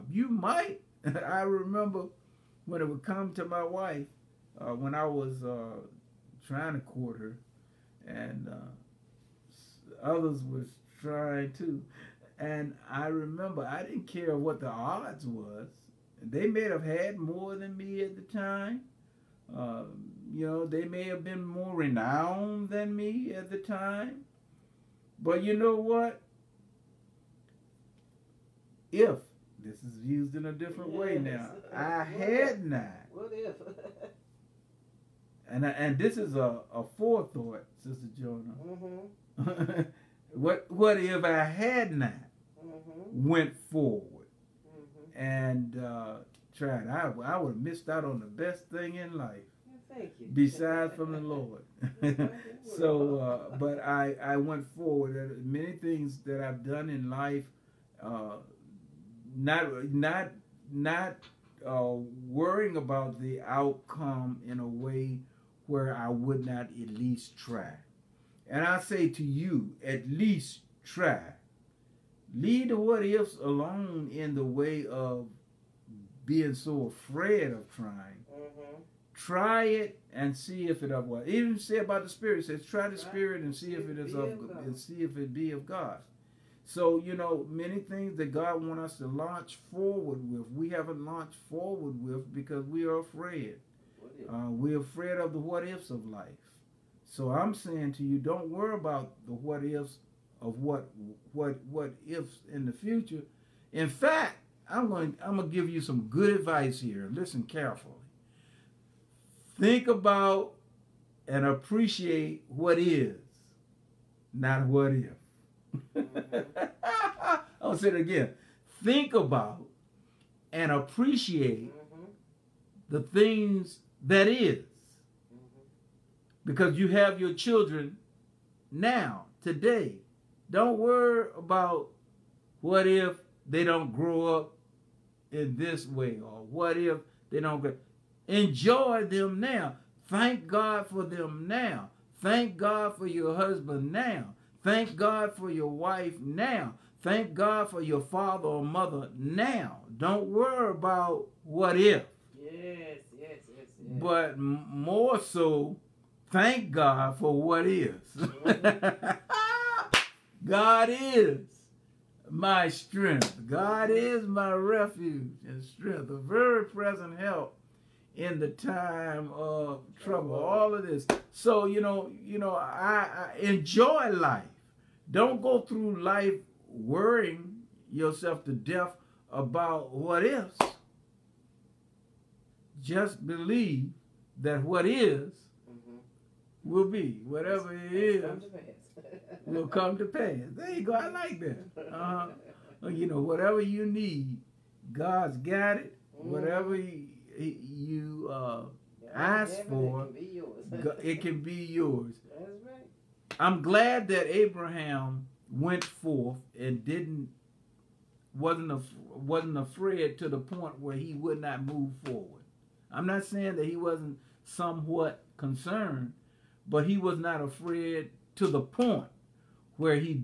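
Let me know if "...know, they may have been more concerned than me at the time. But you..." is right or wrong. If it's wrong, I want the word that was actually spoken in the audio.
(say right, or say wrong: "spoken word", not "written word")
wrong: "renowned", not "concerned".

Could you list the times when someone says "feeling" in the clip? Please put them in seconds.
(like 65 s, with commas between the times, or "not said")
not said.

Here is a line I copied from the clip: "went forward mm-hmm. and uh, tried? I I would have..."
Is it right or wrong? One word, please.
right.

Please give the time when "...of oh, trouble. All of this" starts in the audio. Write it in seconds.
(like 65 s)
169 s.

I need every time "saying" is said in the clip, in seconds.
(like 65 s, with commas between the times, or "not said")
97 s, 213 s.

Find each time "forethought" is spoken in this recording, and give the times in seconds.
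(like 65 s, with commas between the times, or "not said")
36 s.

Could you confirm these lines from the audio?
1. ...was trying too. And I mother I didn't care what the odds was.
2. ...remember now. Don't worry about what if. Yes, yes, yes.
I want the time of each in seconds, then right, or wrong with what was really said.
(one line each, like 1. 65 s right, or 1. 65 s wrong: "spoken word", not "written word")
1. 10 s wrong: "remember", not "mother"
2. 148 s wrong: "mother", not "remember".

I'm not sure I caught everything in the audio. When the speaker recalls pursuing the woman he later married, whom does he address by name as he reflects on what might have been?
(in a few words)
Sister Joyner.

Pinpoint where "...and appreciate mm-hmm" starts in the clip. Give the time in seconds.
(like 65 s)
120 s.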